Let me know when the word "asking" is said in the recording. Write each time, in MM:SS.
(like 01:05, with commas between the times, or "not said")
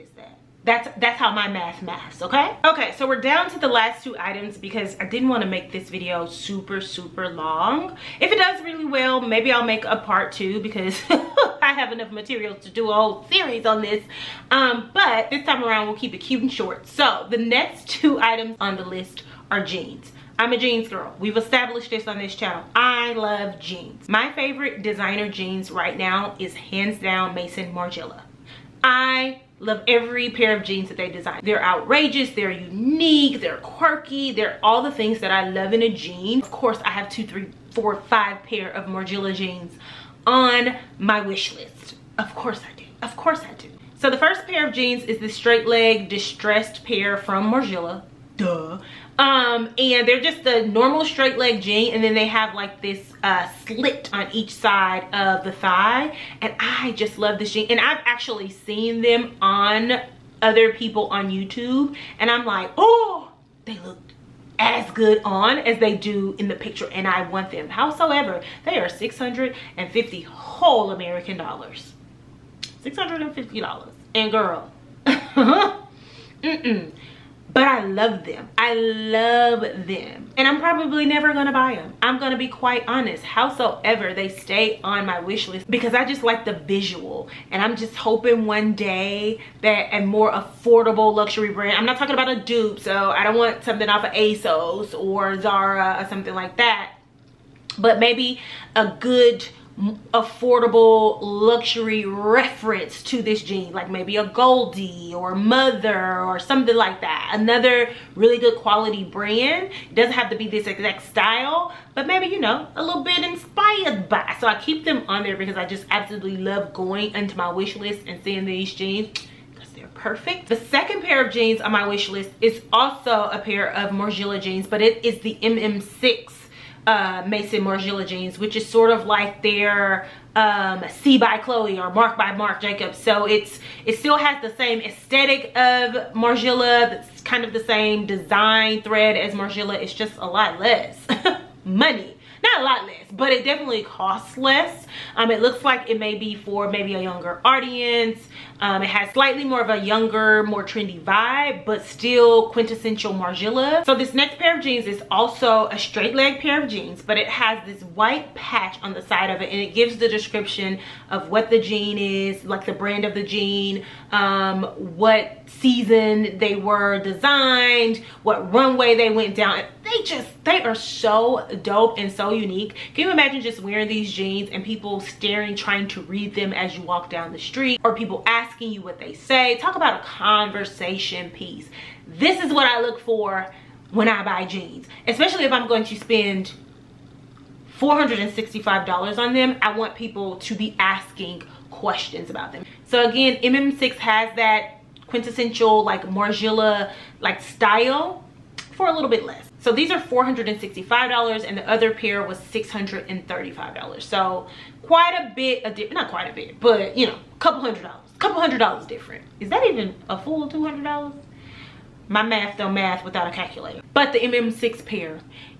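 02:58, 03:10.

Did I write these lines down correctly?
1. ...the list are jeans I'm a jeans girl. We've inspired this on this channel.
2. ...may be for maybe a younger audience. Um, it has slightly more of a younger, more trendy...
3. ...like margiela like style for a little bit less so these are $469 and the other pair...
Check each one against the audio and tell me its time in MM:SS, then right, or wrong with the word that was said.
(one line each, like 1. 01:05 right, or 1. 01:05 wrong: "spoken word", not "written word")
1. 00:18 wrong: "established", not "inspired"
2. 02:25 right
3. 03:15 wrong: "465", not "469".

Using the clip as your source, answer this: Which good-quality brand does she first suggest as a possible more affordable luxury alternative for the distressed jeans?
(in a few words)
AGOLDE.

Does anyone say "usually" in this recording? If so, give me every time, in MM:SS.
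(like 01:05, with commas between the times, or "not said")
not said.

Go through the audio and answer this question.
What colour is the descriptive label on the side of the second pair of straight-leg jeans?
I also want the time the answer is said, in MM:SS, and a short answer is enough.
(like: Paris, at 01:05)
White, at 02:37.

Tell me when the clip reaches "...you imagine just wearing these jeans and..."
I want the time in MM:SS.
02:53.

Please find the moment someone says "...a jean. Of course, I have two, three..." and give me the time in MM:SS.
00:35.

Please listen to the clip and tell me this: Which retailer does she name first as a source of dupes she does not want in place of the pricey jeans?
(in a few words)
ASOS.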